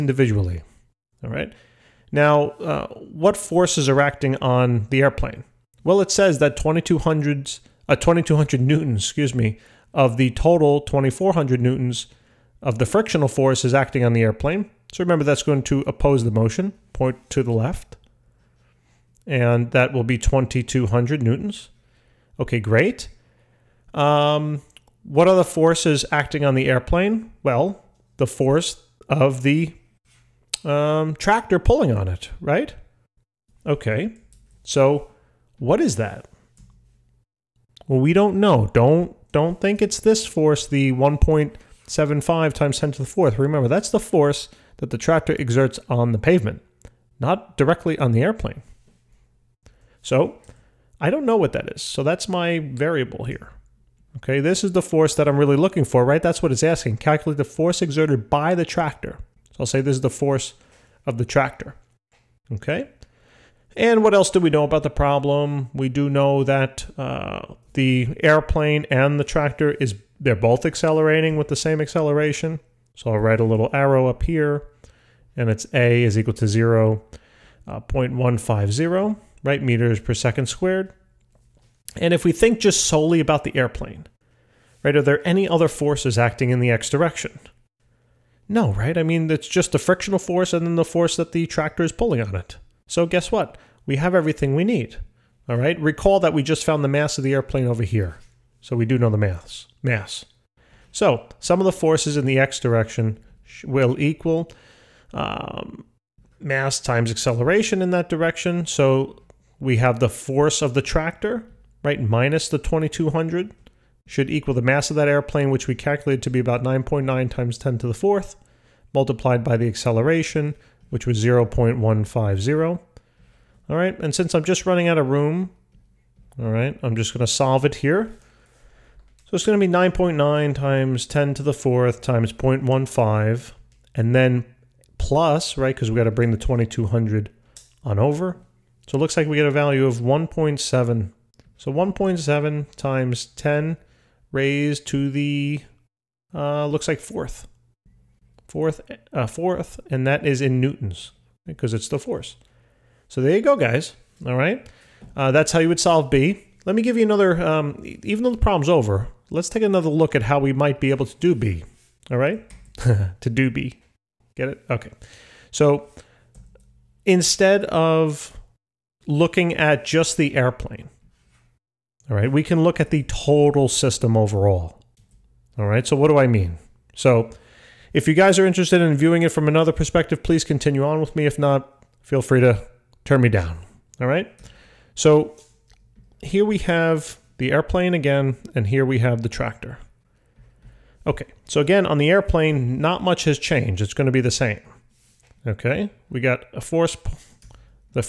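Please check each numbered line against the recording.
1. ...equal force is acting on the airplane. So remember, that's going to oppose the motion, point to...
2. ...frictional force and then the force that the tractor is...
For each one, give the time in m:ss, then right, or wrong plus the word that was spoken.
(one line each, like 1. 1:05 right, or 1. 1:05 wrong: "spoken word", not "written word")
1. 0:12 wrong: "frictional", not "equal"
2. 1:29 right.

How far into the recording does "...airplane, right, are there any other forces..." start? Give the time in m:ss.
1:23.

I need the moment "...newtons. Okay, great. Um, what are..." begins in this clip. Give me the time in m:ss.
0:21.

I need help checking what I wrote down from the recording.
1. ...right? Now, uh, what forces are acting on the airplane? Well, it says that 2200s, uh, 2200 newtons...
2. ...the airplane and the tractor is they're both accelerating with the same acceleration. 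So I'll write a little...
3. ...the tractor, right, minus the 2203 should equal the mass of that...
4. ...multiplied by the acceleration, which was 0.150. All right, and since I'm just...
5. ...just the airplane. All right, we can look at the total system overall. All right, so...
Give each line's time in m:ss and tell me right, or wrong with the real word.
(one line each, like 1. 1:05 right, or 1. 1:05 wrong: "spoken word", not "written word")
1. 0:01 right
2. 1:07 right
3. 1:50 wrong: "2200", not "2203"
4. 1:58 right
5. 2:49 right.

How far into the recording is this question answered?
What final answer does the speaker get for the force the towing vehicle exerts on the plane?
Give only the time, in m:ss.
2:21.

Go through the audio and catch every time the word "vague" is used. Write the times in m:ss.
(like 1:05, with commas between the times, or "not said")
not said.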